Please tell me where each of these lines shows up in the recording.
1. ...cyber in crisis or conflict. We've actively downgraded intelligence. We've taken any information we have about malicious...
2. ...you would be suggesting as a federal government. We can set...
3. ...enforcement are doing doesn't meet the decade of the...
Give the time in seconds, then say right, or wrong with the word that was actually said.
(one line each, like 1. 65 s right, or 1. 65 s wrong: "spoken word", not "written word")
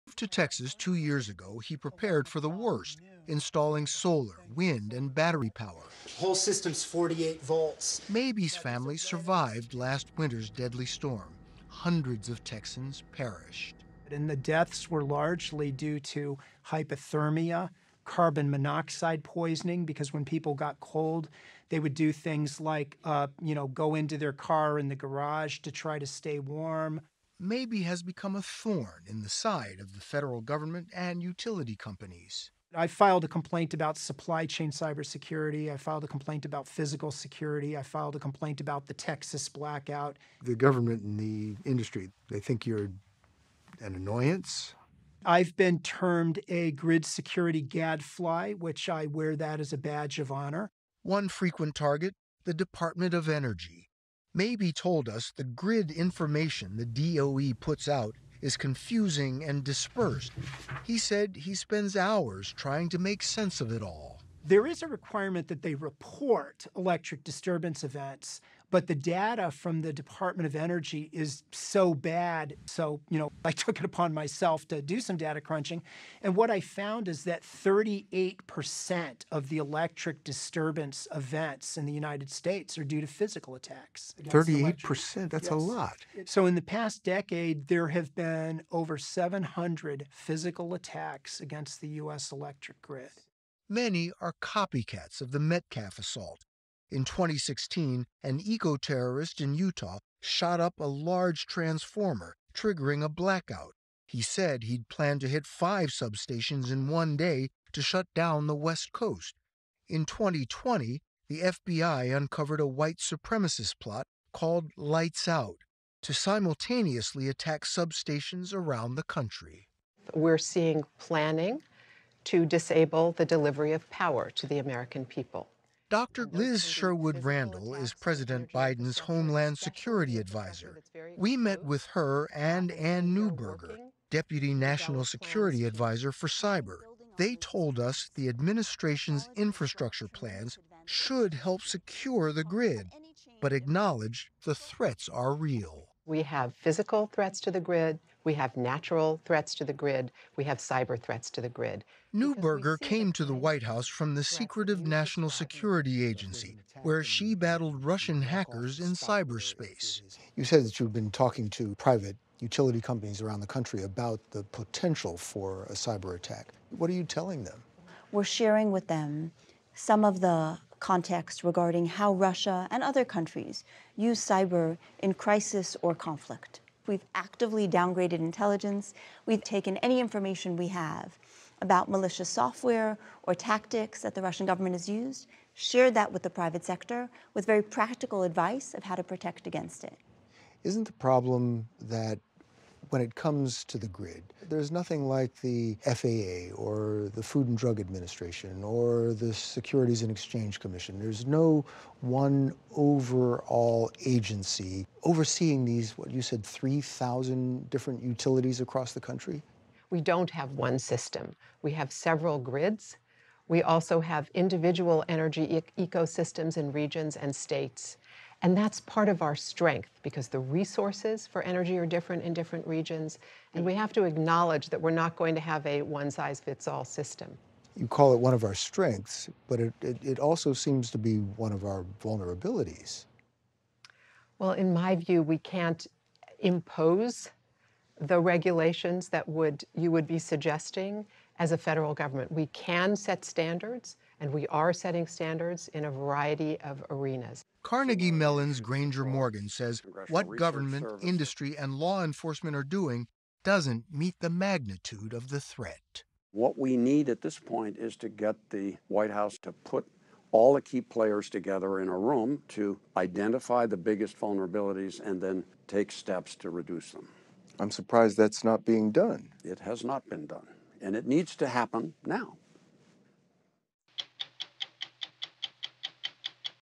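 1. 174 s right
2. 239 s right
3. 252 s wrong: "magnitude", not "decade".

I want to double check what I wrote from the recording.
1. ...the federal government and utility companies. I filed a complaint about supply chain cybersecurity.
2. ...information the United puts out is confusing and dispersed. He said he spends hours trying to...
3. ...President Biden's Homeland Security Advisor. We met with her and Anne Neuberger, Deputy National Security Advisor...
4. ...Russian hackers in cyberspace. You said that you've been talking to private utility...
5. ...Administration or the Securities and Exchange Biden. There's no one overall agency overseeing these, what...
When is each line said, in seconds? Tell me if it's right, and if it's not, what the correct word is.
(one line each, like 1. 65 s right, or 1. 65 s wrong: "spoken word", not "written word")
1. 29 s right
2. 55 s wrong: "DOE", not "United"
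3. 127 s right
4. 157 s right
5. 197 s wrong: "Commission", not "Biden".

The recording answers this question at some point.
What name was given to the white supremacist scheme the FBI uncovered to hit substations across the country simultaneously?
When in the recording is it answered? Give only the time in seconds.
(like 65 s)
114 s.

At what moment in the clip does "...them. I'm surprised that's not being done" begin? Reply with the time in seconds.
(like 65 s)
266 s.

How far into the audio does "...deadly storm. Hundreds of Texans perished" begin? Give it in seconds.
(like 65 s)
10 s.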